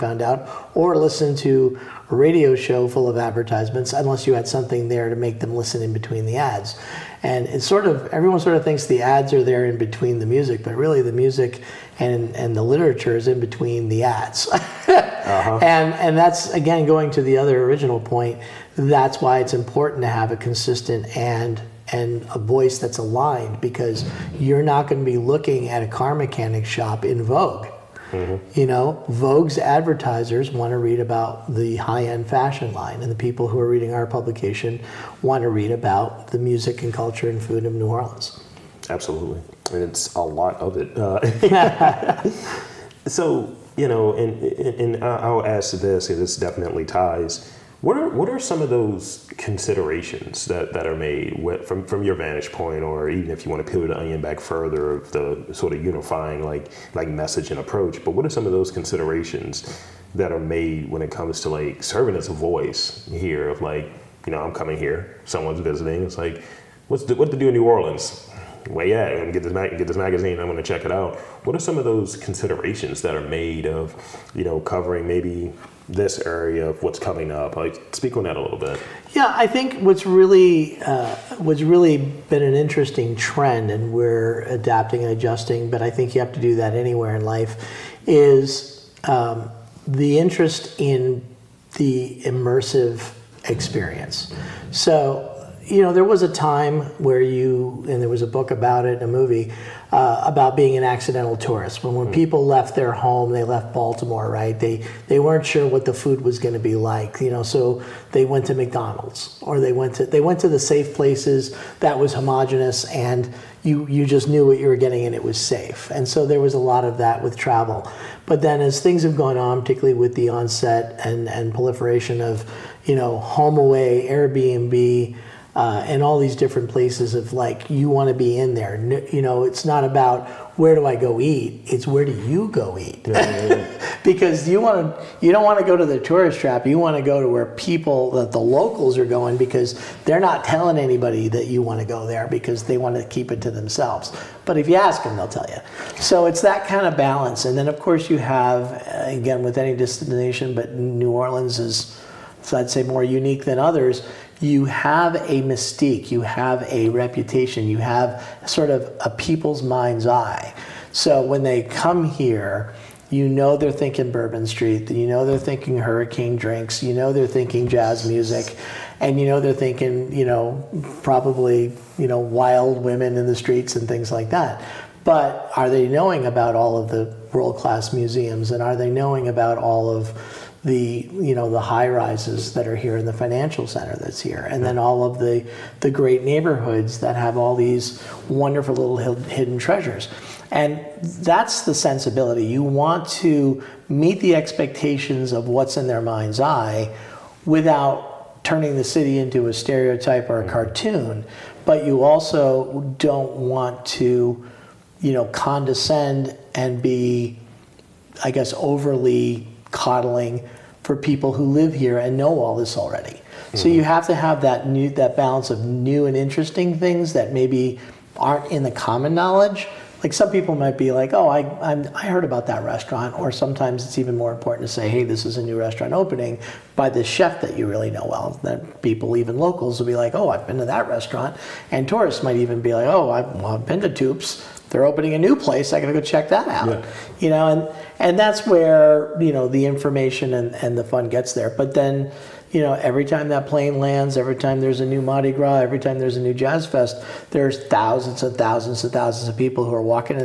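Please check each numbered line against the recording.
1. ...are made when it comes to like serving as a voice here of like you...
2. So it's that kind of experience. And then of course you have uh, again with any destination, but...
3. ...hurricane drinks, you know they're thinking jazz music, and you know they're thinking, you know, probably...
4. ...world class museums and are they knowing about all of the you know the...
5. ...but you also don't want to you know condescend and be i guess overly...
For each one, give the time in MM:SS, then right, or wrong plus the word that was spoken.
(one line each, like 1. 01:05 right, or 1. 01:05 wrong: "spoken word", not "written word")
1. 01:00 right
2. 02:25 wrong: "balance", not "experience"
3. 02:45 right
4. 02:57 right
5. 03:21 right.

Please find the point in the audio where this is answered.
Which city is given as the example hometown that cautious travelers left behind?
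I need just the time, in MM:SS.
01:43.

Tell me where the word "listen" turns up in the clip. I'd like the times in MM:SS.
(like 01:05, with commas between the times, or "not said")
00:00, 00:05.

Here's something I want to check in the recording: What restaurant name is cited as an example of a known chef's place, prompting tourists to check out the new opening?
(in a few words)
Toup's.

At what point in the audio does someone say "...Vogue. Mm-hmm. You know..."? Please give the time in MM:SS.
00:27.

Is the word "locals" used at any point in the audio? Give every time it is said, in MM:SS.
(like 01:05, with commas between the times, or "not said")
02:18, 03:49.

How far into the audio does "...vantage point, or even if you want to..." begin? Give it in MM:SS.
00:52.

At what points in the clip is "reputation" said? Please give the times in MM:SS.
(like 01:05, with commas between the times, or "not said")
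02:36.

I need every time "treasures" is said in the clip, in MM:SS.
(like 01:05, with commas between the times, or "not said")
03:09.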